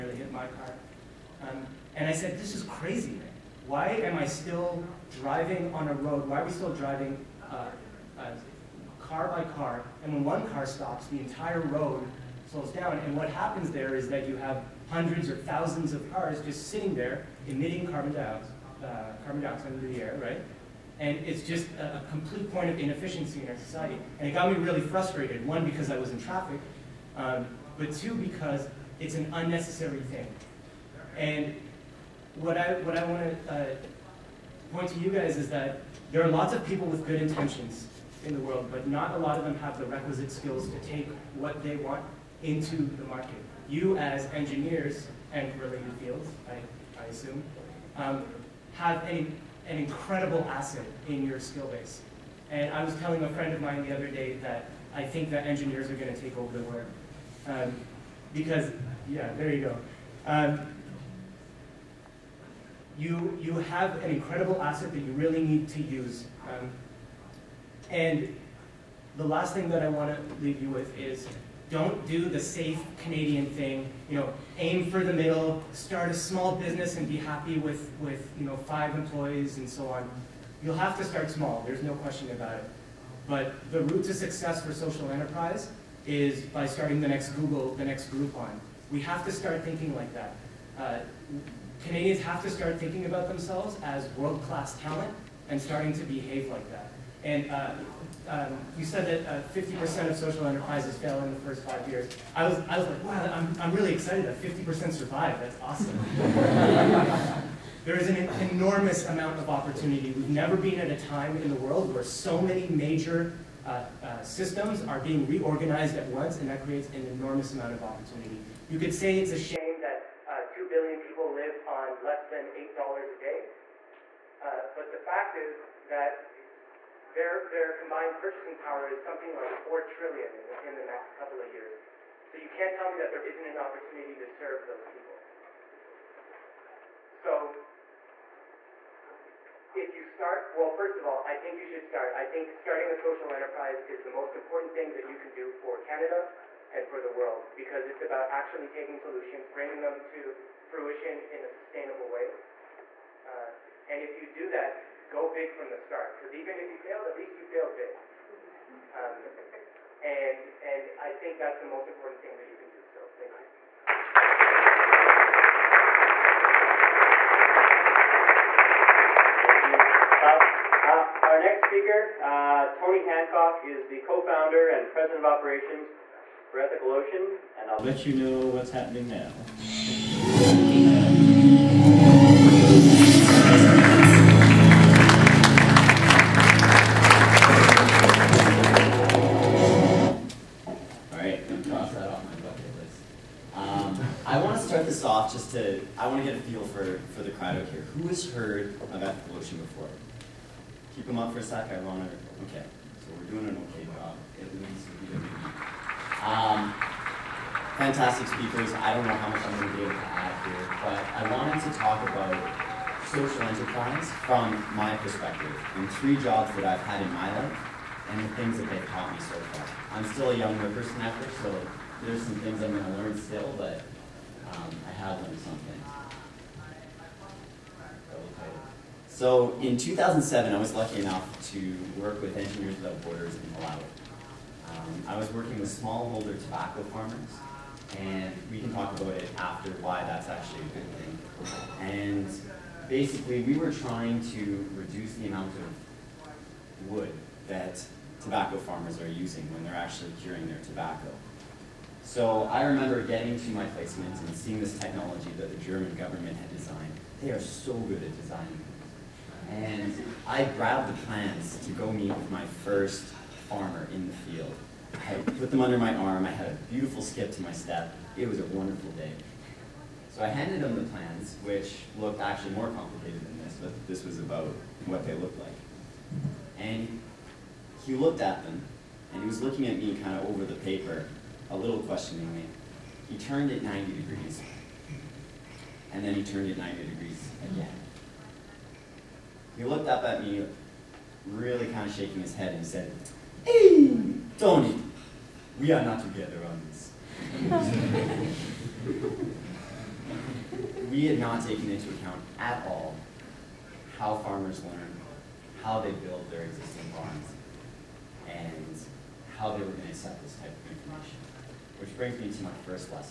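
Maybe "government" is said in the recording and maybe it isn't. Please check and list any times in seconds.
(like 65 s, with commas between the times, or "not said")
255 s.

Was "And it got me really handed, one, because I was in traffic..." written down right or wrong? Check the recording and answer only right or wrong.
wrong.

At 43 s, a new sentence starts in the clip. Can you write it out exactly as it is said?
You as engineers and related fields, I, I assume, um, have a, an incredible asset in your skill base.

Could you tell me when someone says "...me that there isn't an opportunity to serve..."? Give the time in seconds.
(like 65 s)
132 s.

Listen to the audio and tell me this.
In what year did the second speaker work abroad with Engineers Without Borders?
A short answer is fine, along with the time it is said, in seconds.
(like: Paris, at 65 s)
2007, at 229 s.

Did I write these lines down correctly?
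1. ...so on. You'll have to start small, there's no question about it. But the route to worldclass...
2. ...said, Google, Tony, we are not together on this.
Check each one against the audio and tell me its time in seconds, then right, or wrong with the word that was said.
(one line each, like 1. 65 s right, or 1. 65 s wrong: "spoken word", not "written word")
1. 79 s wrong: "success", not "worldclass"
2. 292 s wrong: "Hey", not "Google".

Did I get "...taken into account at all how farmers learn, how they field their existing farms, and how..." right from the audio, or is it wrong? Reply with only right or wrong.
wrong.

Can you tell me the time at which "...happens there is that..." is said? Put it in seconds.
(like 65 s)
13 s.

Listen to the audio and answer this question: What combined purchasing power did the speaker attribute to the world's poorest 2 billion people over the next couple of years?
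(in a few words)
4 trillion.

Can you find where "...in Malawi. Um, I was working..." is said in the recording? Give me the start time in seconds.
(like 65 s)
233 s.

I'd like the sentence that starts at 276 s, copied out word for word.
And he looked at them, and he was looking at me kind of over the paper, a little questioningly.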